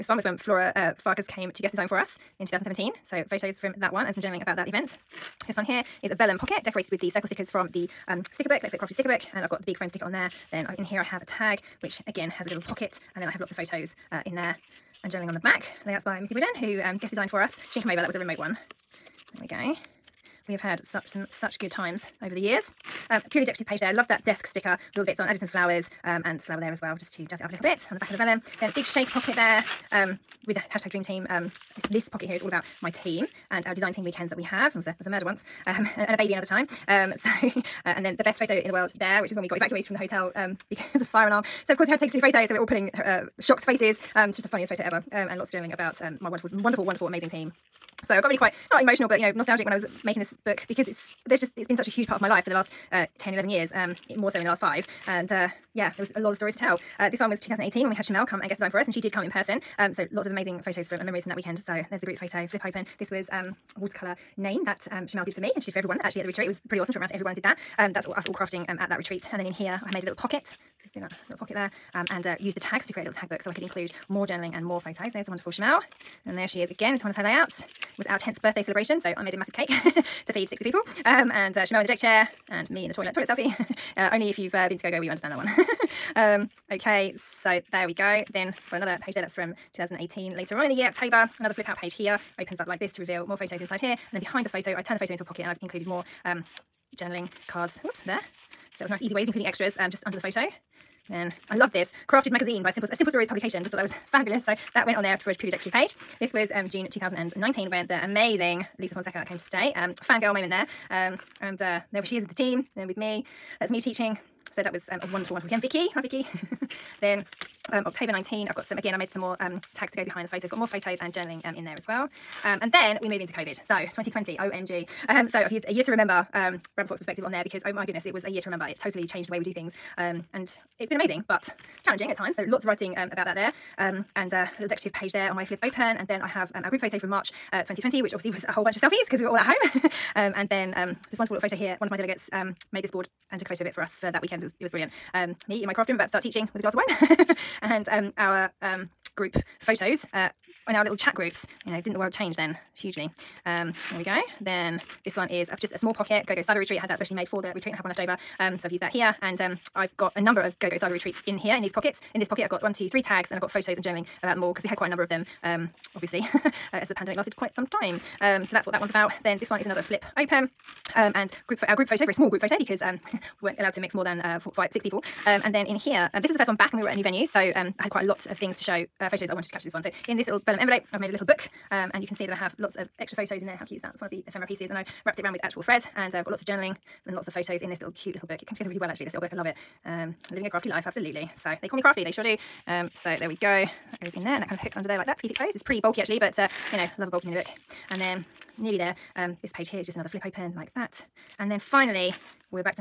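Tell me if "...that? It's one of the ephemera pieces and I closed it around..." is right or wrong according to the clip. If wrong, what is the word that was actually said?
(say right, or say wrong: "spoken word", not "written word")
wrong: "wrapped", not "closed".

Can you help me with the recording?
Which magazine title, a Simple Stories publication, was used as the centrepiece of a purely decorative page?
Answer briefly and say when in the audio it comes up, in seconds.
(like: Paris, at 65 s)
Crafted Magazine, at 102 s.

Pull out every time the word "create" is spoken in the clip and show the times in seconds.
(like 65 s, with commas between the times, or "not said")
72 s.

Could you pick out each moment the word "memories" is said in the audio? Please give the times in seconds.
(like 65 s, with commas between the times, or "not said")
61 s.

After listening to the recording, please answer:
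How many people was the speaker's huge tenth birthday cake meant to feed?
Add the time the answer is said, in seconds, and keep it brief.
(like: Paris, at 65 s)
60, at 80 s.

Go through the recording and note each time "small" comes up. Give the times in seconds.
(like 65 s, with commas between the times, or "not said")
155 s, 172 s.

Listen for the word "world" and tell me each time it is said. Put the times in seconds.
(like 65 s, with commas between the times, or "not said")
38 s, 151 s.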